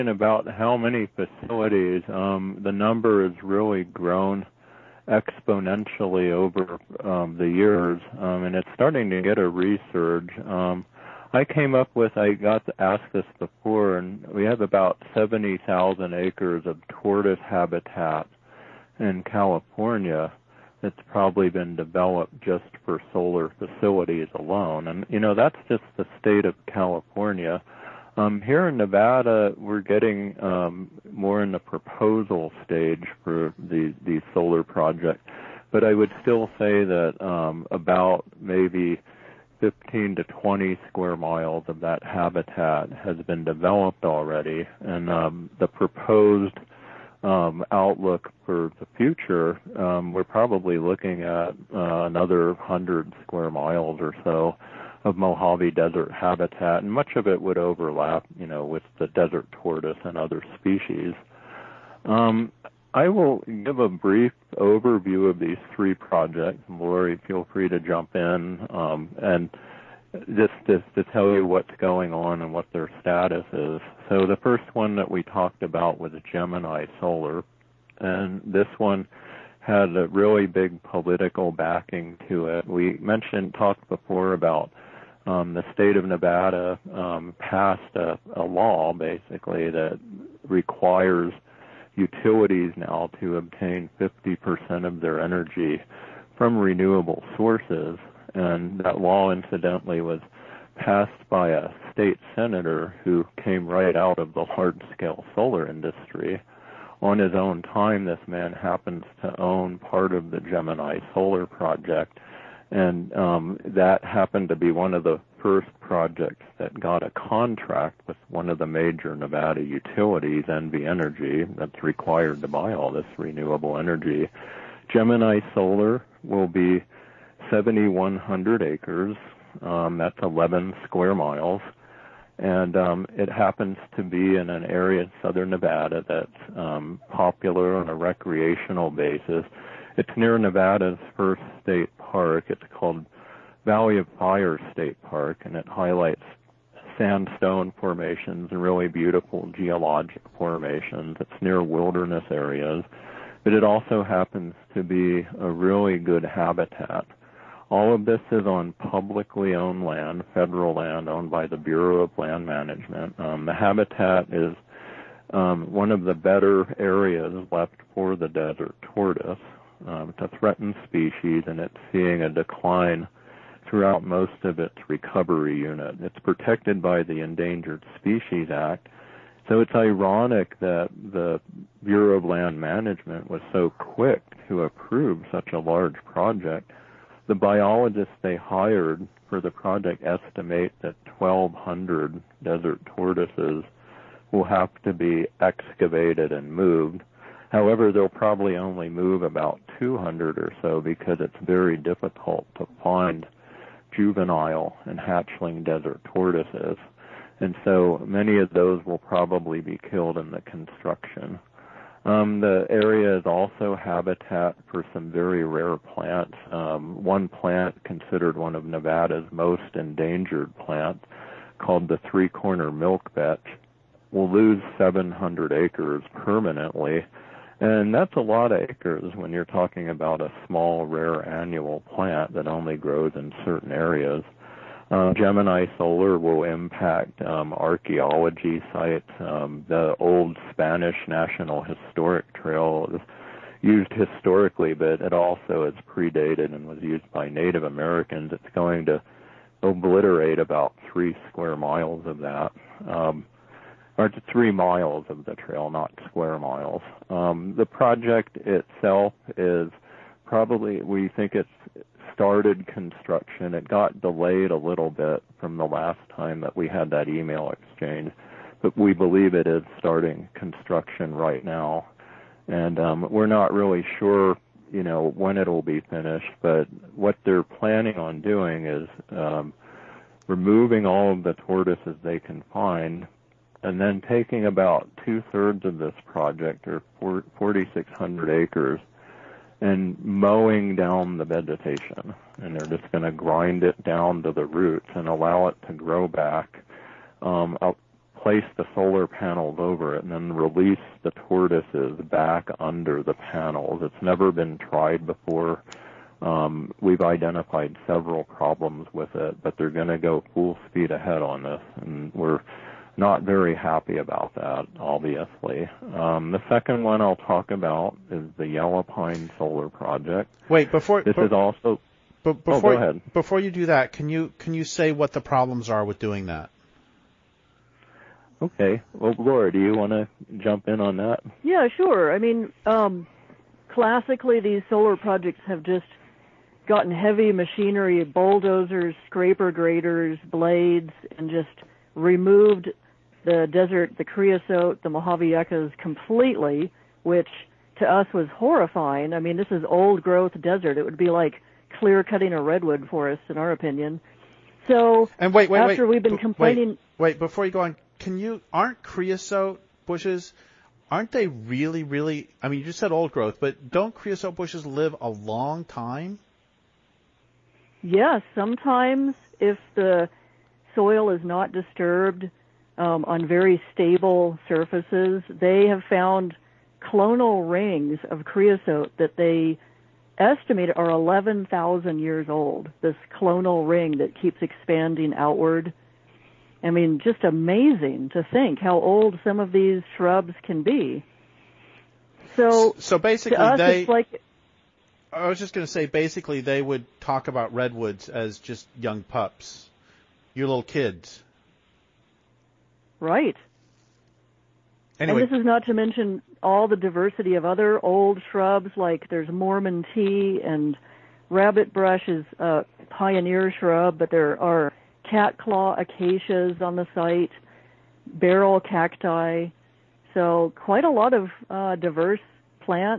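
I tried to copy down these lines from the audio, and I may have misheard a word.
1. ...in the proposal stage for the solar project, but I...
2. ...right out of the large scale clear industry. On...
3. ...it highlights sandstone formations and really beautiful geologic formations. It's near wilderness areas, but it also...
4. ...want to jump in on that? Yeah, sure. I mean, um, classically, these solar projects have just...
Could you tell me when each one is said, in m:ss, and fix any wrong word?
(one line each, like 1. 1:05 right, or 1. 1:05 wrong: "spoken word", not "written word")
1. 0:31 right
2. 1:43 wrong: "solar", not "clear"
3. 2:25 right
4. 5:29 right.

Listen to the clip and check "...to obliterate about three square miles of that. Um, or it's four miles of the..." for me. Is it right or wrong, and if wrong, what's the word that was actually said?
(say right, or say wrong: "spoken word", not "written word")
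wrong: "three", not "four".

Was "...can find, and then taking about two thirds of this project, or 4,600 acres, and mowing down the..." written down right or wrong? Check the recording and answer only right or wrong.
right.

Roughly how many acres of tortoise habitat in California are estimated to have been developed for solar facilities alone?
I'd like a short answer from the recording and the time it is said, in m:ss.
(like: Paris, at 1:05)
70,000 acres, at 0:15.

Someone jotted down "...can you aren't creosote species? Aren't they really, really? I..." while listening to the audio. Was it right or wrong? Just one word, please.
wrong.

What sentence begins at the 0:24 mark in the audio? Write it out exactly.
And, you know, that's just the state of California.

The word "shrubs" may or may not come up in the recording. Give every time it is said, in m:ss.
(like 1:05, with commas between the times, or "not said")
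6:29, 6:48, 6:53.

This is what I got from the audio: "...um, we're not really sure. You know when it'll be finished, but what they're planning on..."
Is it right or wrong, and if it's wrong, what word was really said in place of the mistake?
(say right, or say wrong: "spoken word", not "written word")
right.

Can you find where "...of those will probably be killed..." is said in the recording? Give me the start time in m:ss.
3:28.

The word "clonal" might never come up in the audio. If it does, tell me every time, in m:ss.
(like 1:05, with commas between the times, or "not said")
6:16, 6:23.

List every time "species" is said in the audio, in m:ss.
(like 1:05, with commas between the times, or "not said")
1:00, 2:50, 2:57.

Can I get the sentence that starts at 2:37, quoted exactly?
All of this is on publicly owned land, federal land owned by the Bureau of Land Management.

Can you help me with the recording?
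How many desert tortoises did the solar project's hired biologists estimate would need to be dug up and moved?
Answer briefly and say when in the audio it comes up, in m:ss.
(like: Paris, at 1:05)
1,200, at 3:11.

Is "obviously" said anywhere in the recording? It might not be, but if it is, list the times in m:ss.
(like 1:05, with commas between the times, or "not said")
5:14.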